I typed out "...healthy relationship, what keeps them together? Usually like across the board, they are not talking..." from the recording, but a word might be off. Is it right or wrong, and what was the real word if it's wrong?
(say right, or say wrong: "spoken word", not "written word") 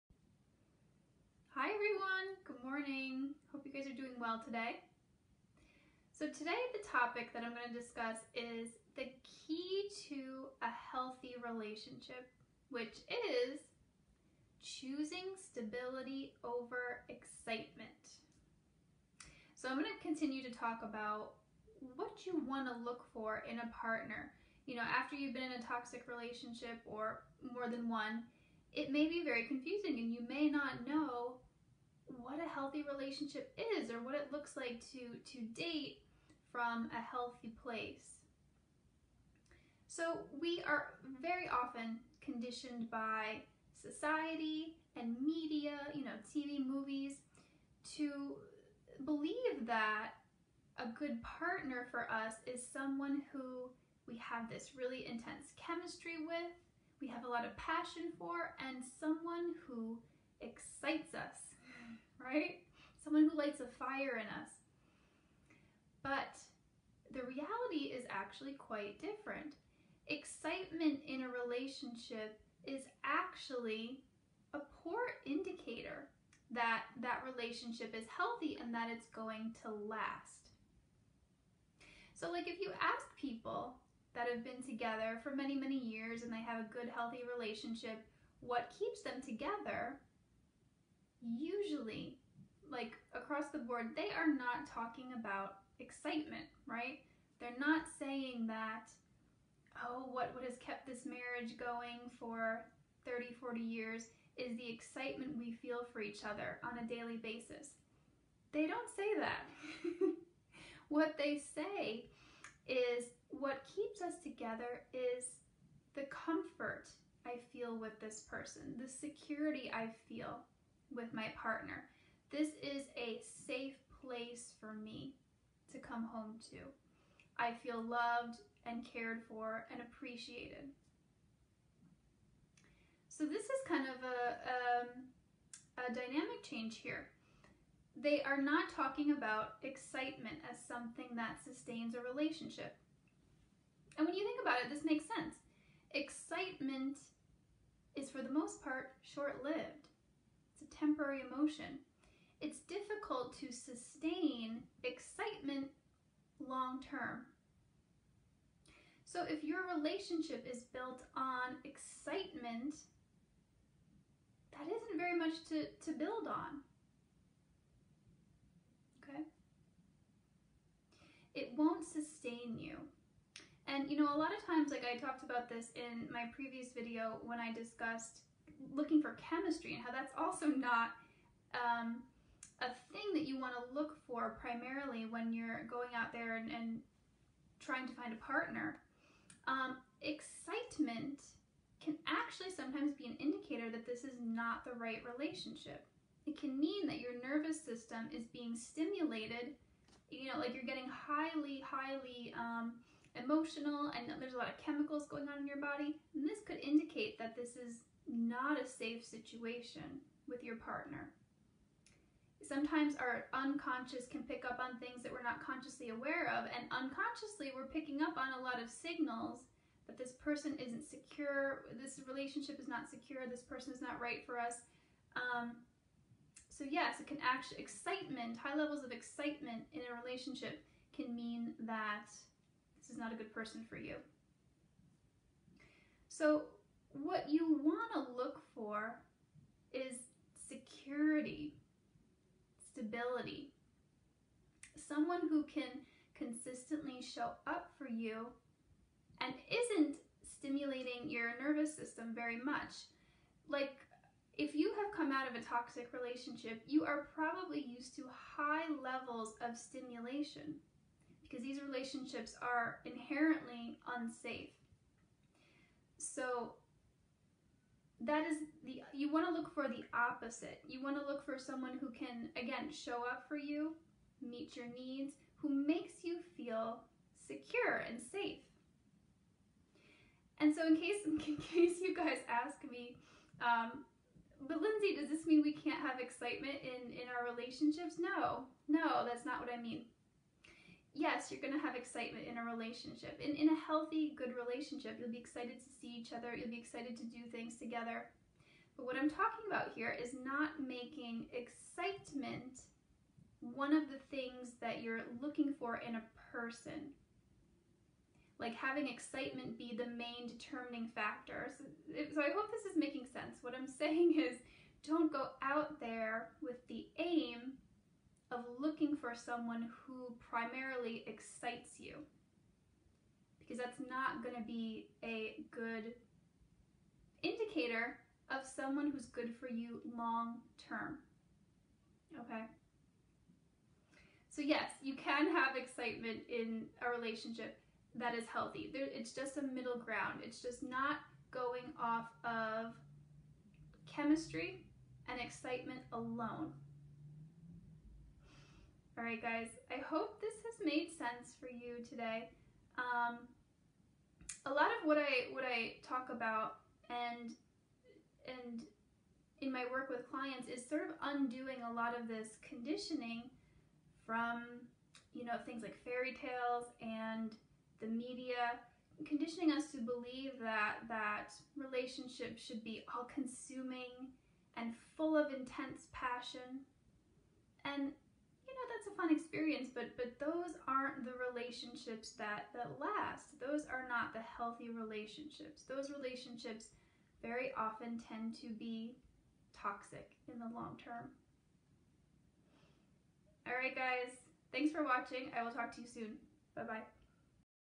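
right.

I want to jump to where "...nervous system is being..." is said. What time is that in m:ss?
3:17.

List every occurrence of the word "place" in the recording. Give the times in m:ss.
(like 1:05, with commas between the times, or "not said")
0:37, 2:04.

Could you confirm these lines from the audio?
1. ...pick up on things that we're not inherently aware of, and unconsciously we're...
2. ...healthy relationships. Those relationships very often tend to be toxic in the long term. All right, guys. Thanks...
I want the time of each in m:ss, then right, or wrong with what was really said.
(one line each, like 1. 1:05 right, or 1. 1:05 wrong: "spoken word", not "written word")
1. 3:34 wrong: "consciously", not "inherently"
2. 6:24 right.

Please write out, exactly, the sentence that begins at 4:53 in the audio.
In, in a healthy, good relationship, you'll be excited to see each other, you'll be excited to do things together.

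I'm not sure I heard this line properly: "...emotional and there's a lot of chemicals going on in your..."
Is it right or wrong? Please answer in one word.
right.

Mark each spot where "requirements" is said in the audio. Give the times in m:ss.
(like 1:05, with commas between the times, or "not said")
not said.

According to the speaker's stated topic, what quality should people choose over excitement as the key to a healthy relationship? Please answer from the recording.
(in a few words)
stability.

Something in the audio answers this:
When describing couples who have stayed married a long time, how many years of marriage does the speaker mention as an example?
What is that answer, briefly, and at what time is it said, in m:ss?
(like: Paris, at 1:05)
30 or 40 years, at 1:43.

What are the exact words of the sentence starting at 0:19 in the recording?
So I'm going to continue to talk about what you want to look for in a partner.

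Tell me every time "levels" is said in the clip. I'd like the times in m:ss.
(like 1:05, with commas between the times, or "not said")
3:48, 4:18.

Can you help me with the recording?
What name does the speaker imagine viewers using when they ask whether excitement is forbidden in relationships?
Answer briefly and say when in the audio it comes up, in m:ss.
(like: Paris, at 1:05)
Lindsay, at 4:44.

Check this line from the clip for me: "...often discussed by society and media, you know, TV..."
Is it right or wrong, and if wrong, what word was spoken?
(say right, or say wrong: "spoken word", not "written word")
wrong: "conditioned", not "discussed".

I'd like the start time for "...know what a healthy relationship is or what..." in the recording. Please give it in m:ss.
0:30.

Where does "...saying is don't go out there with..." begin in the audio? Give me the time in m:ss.
5:13.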